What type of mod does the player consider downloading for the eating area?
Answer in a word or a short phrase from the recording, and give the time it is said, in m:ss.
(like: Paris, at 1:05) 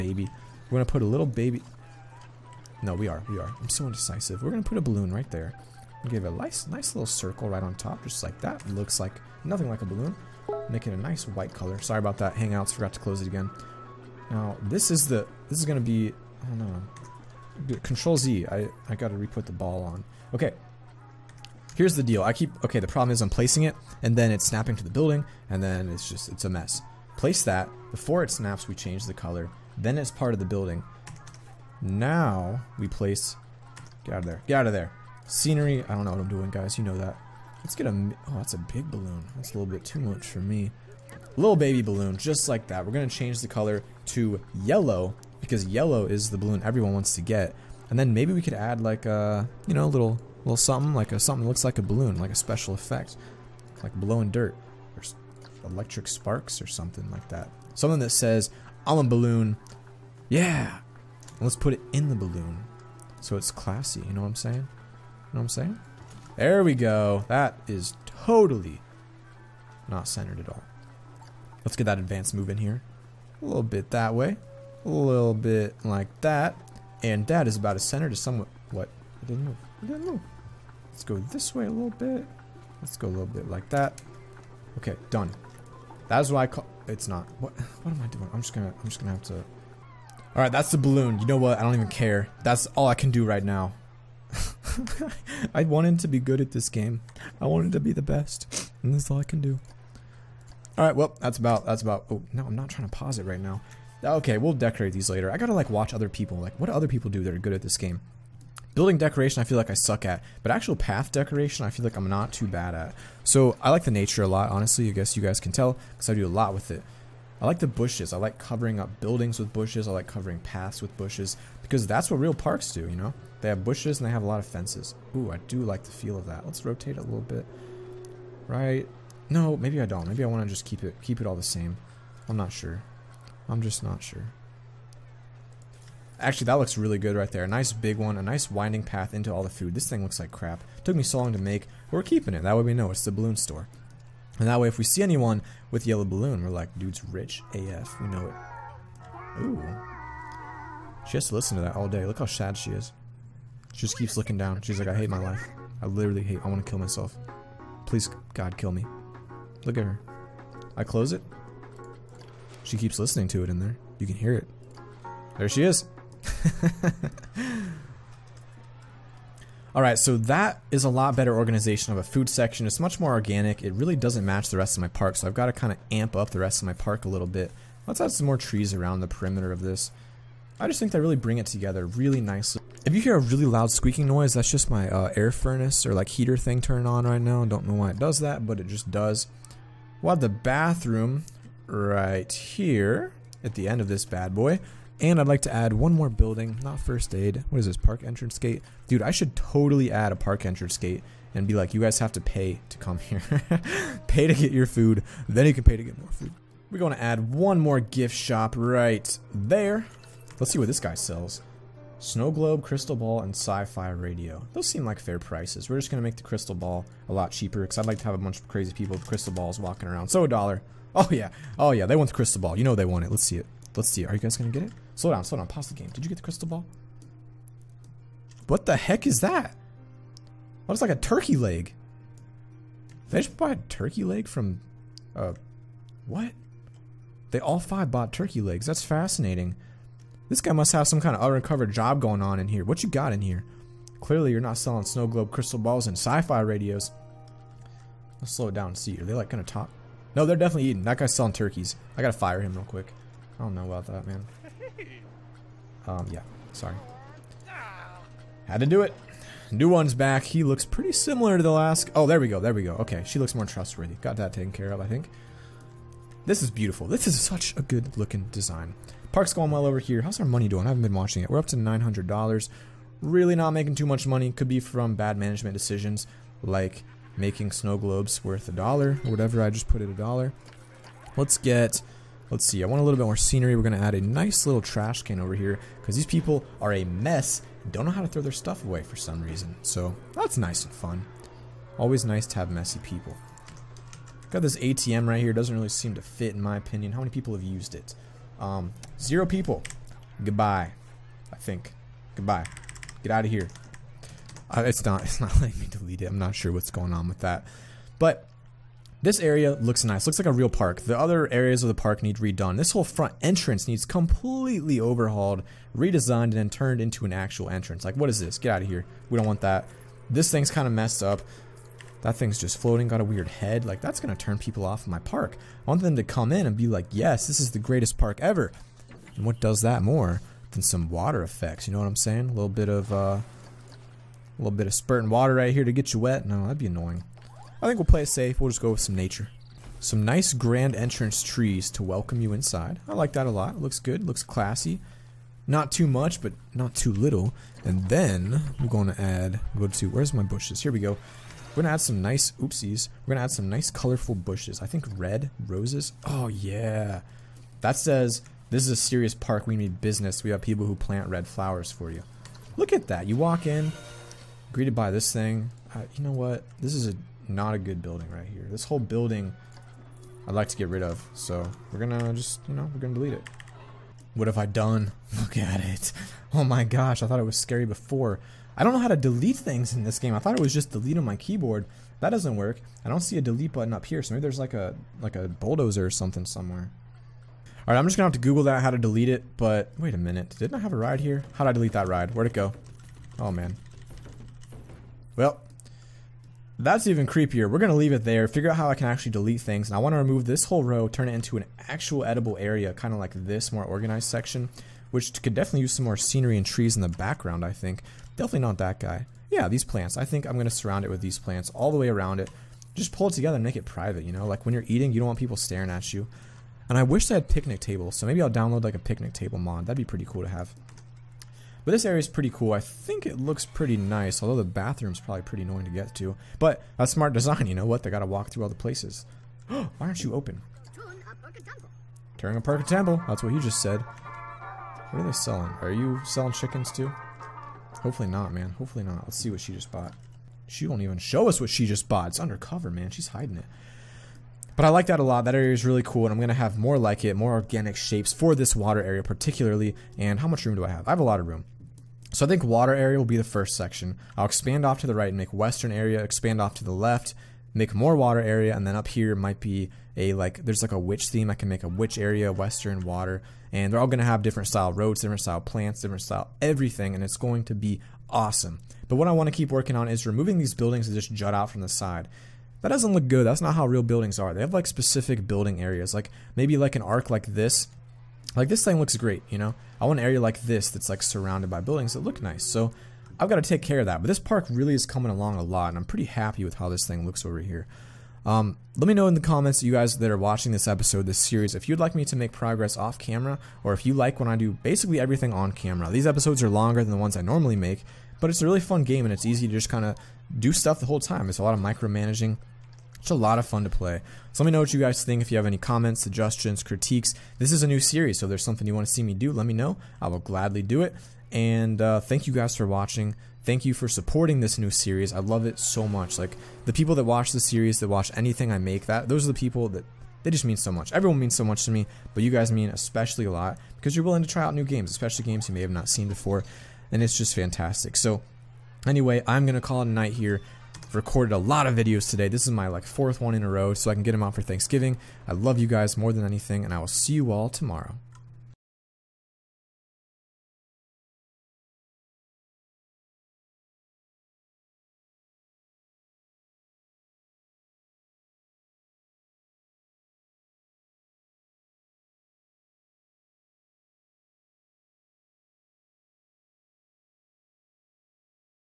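Picnic table mod, at 6:58.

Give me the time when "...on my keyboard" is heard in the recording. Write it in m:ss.
6:20.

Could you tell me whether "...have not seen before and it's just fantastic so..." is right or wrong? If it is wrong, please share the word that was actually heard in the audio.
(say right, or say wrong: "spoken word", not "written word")
right.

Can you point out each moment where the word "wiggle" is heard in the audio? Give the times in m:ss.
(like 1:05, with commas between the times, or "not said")
not said.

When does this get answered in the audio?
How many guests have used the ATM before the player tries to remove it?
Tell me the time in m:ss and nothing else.
4:59.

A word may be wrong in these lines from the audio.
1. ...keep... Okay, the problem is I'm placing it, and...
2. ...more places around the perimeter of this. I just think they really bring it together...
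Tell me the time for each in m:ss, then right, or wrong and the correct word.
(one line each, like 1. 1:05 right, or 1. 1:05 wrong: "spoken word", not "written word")
1. 0:22 right
2. 2:58 wrong: "trees", not "places".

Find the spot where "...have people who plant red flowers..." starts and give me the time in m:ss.
6:00.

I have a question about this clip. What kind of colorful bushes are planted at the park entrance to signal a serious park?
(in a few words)
Red roses.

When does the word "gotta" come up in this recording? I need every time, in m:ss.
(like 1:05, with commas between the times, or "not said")
1:45, 4:12, 7:07.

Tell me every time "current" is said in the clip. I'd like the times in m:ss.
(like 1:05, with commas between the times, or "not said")
not said.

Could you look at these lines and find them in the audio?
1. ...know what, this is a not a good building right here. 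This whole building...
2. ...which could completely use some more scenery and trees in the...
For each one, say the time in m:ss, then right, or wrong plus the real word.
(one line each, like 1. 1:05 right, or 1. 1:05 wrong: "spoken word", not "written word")
1. 6:06 right
2. 6:44 wrong: "definitely", not "completely".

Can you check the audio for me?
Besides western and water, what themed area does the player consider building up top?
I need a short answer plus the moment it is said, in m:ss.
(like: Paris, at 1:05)
Witch area, at 7:41.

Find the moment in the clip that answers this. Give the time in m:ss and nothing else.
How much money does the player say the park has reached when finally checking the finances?
4:31.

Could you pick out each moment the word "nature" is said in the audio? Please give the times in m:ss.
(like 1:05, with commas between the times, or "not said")
1:53, 5:38.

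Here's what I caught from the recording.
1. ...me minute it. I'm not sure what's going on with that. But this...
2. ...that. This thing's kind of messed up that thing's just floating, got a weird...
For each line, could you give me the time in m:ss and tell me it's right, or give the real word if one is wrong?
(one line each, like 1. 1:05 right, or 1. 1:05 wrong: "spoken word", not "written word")
1. 5:05 wrong: "delete", not "minute"
2. 5:19 right.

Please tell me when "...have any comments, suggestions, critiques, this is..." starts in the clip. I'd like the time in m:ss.
8:25.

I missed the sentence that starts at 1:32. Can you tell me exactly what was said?
That's all I can do right now.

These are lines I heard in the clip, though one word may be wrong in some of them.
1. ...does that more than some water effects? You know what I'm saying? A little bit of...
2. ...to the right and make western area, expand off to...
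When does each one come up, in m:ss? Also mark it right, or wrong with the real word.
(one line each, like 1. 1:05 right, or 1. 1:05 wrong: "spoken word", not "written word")
1. 5:29 right
2. 7:34 right.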